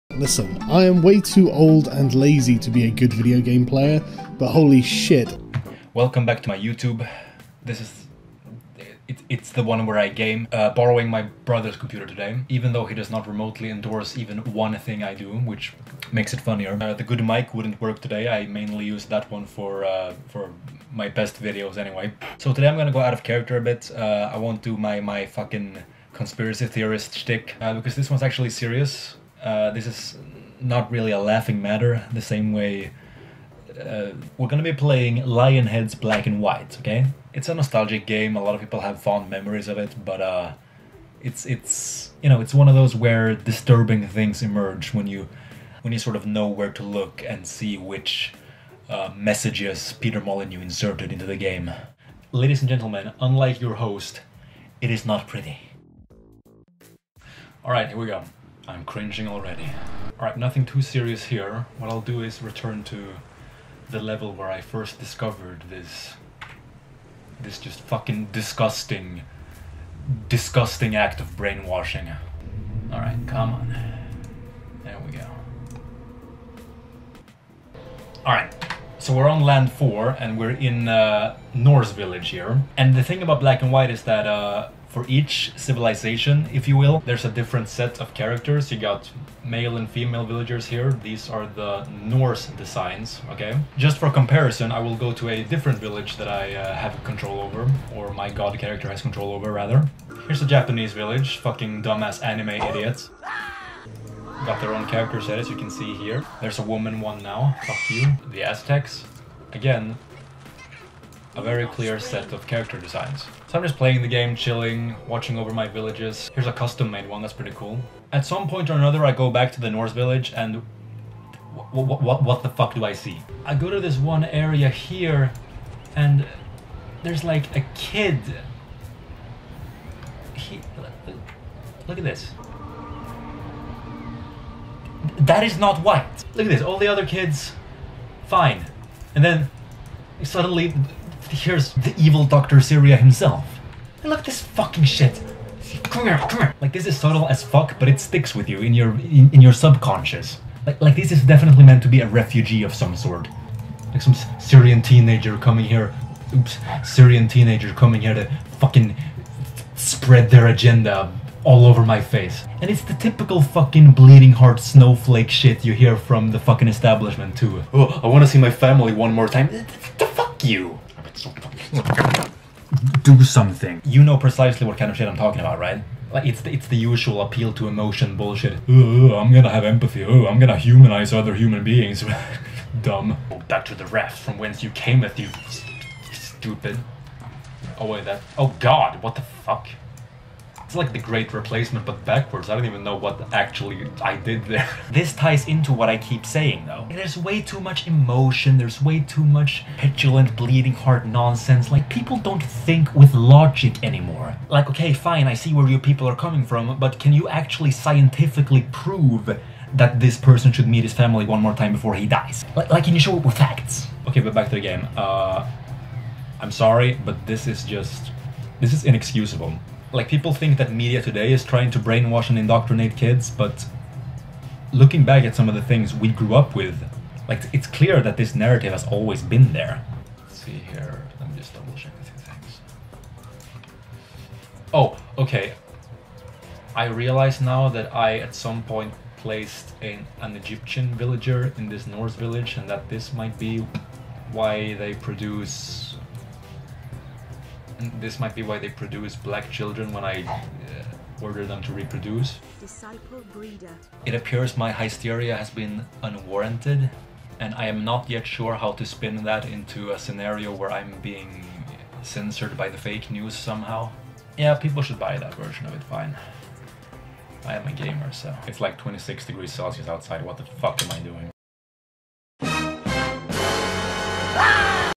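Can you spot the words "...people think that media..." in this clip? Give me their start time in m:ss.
3:40.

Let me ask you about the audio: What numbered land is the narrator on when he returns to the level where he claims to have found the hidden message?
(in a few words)
4.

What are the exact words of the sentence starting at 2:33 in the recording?
Like some Syrian teenager coming here.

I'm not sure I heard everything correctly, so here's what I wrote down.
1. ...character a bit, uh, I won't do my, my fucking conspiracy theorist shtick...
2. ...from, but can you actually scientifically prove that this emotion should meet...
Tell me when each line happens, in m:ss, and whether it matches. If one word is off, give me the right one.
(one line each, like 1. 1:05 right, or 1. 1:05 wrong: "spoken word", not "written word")
1. 0:23 right
2. 3:26 wrong: "person", not "emotion".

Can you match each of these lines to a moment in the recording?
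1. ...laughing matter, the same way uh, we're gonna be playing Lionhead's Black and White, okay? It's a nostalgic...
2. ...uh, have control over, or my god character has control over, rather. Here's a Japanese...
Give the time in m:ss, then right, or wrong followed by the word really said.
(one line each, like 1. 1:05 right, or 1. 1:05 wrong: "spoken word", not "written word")
1. 0:31 right
2. 1:36 right.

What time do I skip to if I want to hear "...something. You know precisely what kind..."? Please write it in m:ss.
2:53.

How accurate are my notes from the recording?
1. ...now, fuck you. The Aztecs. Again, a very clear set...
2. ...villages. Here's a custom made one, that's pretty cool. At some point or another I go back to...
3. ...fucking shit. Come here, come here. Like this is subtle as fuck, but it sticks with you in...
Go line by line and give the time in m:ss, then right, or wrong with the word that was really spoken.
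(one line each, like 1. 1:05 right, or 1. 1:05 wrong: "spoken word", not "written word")
1. 1:47 right
2. 1:55 right
3. 2:24 right.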